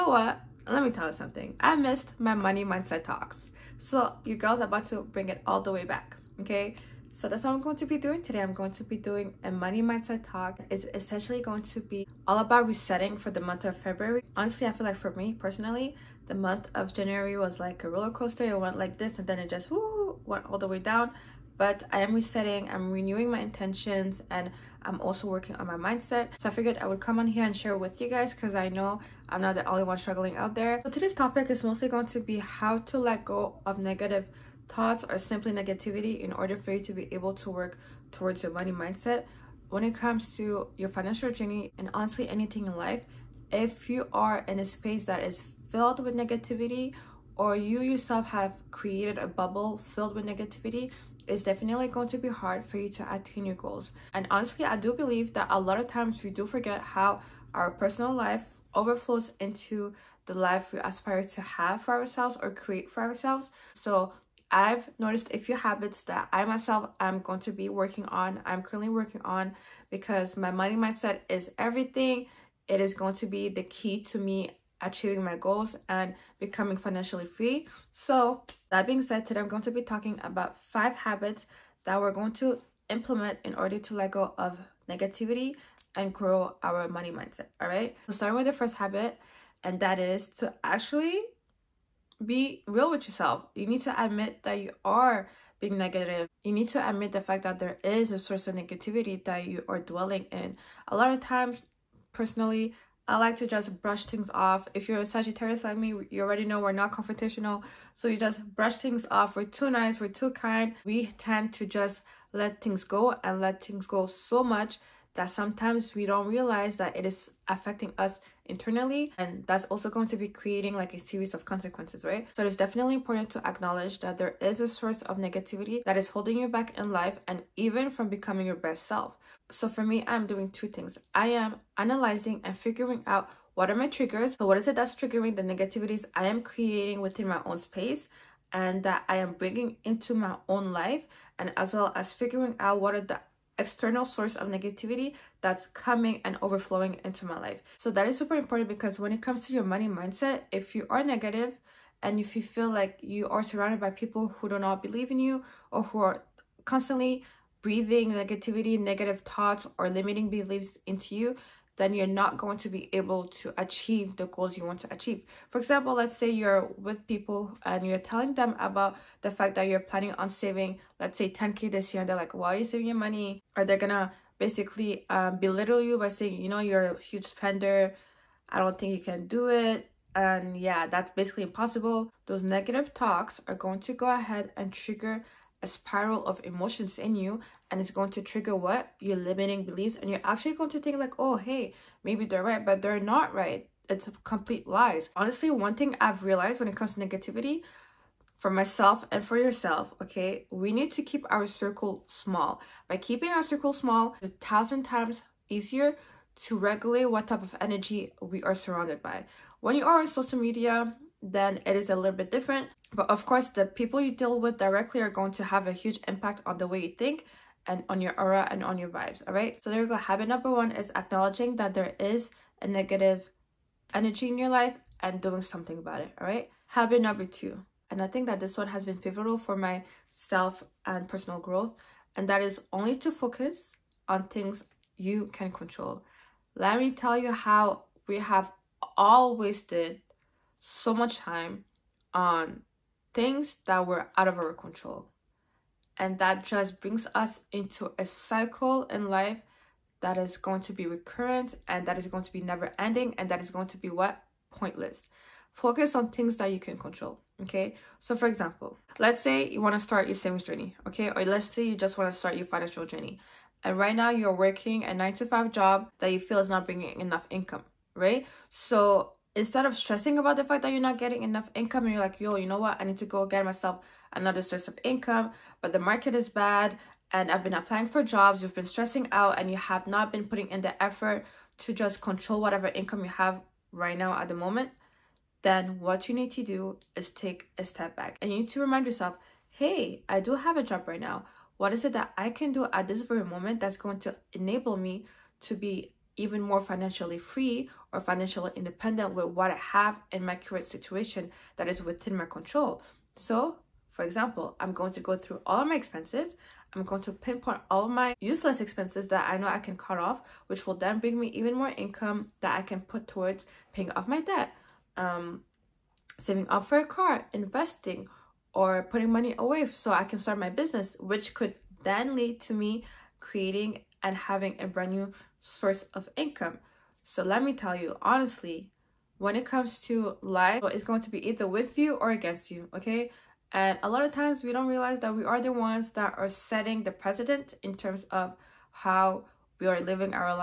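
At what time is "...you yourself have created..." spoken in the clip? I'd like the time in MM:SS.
00:47.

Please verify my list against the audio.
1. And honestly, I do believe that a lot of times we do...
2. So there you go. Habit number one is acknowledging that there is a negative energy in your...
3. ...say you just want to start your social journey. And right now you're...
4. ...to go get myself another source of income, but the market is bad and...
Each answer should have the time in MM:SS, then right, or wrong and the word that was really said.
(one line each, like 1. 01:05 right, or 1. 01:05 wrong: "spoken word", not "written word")
1. 00:54 right
2. 03:39 right
3. 04:21 wrong: "financial", not "social"
4. 04:32 right.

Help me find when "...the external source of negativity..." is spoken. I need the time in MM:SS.
02:22.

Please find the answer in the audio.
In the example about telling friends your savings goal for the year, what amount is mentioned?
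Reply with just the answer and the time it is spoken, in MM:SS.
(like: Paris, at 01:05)
10K, at 02:51.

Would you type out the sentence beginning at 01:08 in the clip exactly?
I'm currently working on because my money mindset is everything.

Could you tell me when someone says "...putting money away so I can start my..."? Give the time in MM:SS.
05:18.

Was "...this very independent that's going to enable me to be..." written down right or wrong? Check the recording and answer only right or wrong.
wrong.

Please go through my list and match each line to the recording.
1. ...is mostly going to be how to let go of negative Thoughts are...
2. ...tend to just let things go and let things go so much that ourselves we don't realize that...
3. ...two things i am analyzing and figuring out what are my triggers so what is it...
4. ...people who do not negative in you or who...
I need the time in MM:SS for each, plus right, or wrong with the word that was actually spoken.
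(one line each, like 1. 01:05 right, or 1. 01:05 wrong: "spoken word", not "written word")
1. 00:31 right
2. 01:51 wrong: "sometimes", not "ourselves"
3. 02:10 right
4. 02:33 wrong: "believe", not "negative".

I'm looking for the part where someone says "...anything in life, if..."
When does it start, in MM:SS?
00:42.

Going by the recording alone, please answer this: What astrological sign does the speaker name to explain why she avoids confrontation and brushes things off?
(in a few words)
Sagittarius.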